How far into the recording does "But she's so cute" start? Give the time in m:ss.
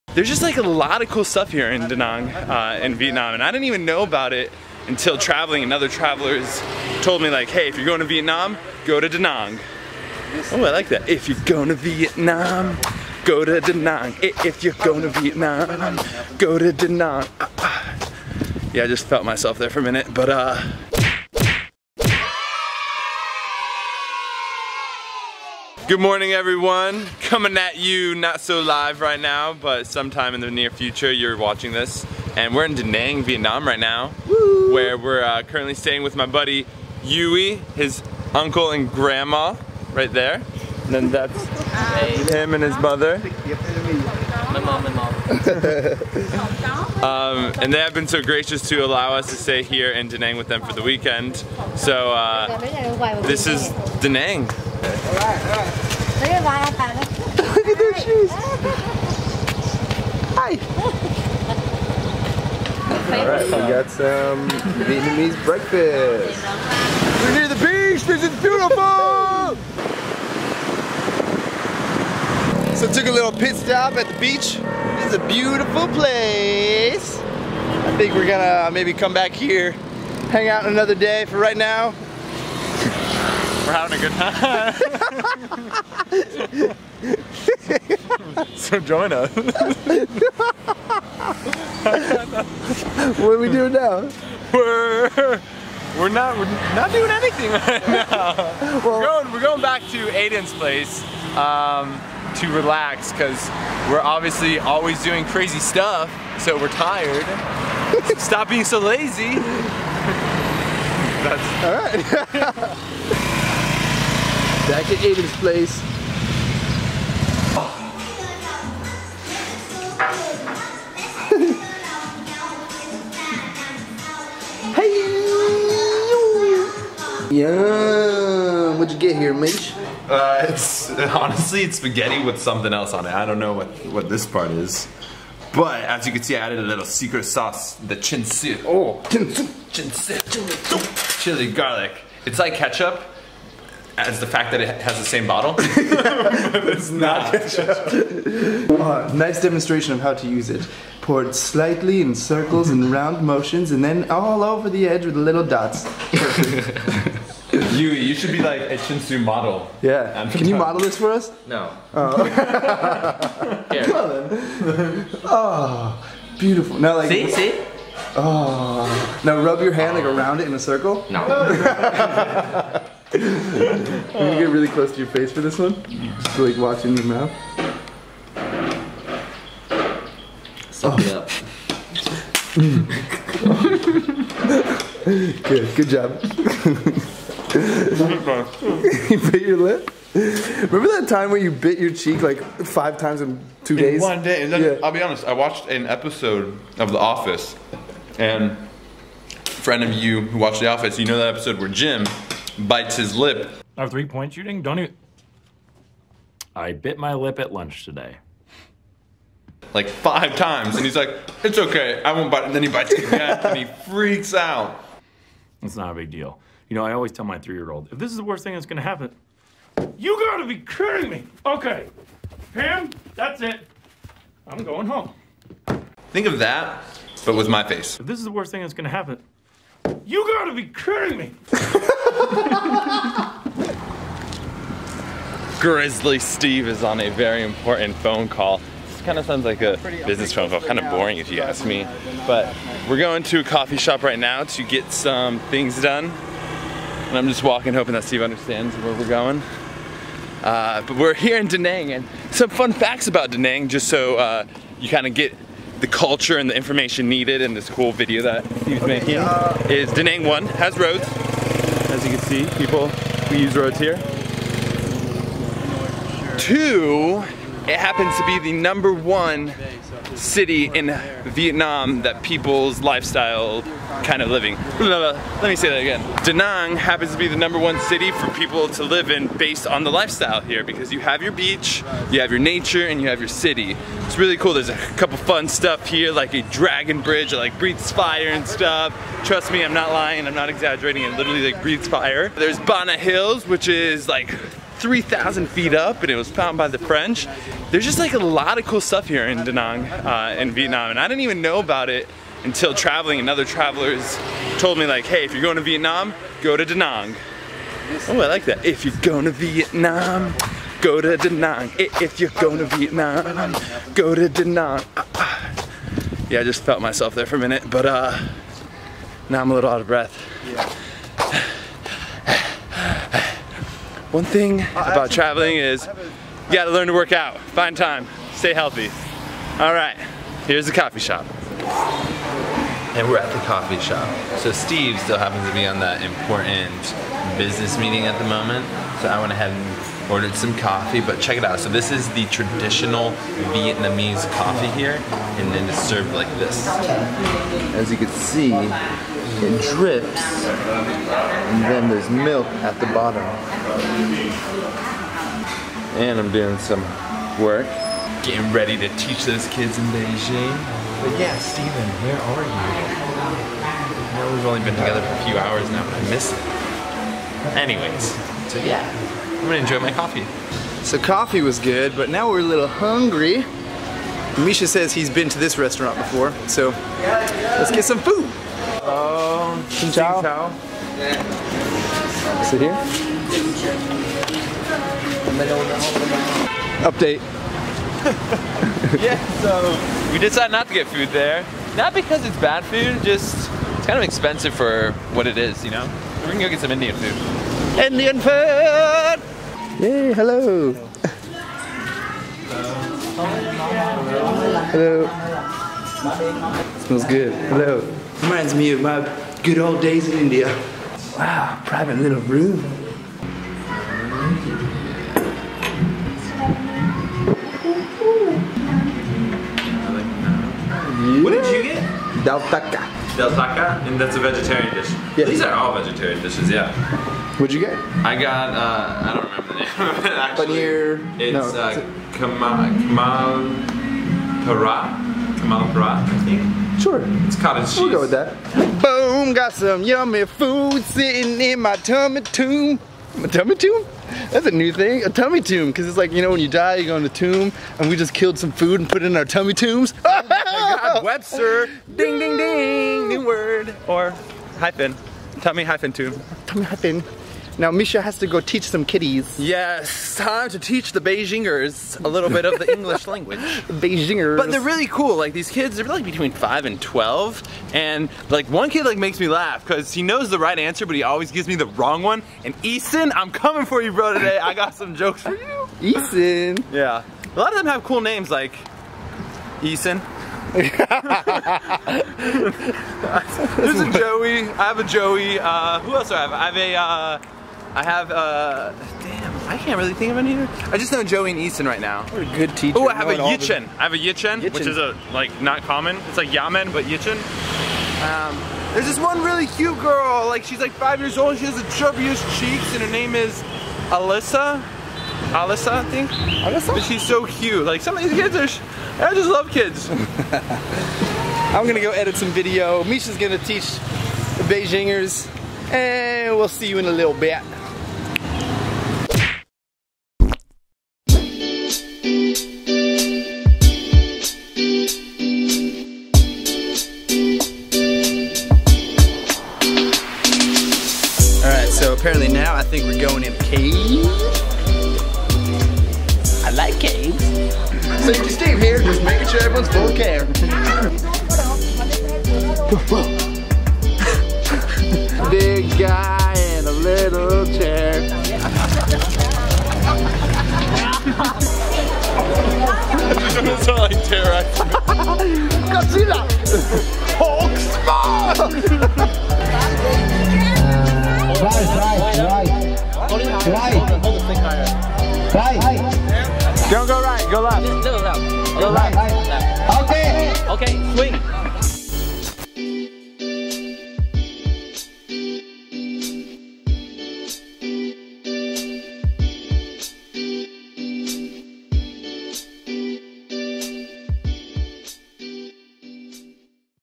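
8:26.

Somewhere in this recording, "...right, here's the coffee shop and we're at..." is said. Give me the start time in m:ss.
5:29.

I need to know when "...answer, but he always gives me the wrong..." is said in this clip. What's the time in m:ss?
7:50.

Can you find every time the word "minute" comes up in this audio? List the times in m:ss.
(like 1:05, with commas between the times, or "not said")
0:19, 5:17.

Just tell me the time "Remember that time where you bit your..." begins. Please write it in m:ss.
3:10.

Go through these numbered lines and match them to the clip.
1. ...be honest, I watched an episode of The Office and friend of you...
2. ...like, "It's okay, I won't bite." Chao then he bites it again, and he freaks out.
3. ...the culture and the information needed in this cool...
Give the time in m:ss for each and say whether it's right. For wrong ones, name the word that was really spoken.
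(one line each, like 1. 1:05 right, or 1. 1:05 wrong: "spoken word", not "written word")
1. 3:14 right
2. 3:30 wrong: "And", not "Chao"
3. 4:15 right.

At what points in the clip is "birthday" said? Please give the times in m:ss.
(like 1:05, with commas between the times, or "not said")
not said.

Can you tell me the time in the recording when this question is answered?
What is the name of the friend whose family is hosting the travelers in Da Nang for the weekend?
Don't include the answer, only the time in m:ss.
0:37.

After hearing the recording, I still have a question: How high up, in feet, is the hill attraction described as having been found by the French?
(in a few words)
3,000 feet.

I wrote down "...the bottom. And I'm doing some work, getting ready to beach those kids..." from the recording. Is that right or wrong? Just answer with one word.
wrong.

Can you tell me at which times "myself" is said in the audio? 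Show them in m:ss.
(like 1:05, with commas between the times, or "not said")
0:19, 5:16.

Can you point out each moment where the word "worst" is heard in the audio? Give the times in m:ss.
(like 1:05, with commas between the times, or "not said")
3:38, 3:48.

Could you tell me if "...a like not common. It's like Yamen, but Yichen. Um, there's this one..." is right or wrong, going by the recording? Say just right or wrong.
right.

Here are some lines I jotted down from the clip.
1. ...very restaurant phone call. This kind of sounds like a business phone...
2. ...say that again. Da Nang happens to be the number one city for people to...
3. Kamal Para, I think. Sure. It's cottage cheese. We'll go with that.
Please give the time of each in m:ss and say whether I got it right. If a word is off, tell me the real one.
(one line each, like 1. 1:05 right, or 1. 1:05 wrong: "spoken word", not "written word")
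1. 3:57 wrong: "important", not "restaurant"
2. 4:35 right
3. 7:15 right.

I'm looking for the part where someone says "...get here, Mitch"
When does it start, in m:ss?
2:08.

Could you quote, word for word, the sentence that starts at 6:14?
Misha says he's been to this restaurant before, so let's get some food.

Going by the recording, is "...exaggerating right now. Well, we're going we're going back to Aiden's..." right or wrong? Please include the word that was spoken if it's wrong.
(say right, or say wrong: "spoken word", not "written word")
wrong: "anything", not "exaggerating".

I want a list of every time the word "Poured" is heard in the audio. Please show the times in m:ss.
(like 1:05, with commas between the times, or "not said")
2:31.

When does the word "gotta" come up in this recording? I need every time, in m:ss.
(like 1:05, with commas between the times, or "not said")
3:40, 3:50, 5:26.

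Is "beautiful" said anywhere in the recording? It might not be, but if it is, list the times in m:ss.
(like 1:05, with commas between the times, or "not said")
1:08, 1:15, 2:46.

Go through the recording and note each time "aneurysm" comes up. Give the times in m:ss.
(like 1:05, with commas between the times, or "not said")
not said.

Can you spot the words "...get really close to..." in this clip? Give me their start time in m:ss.
2:54.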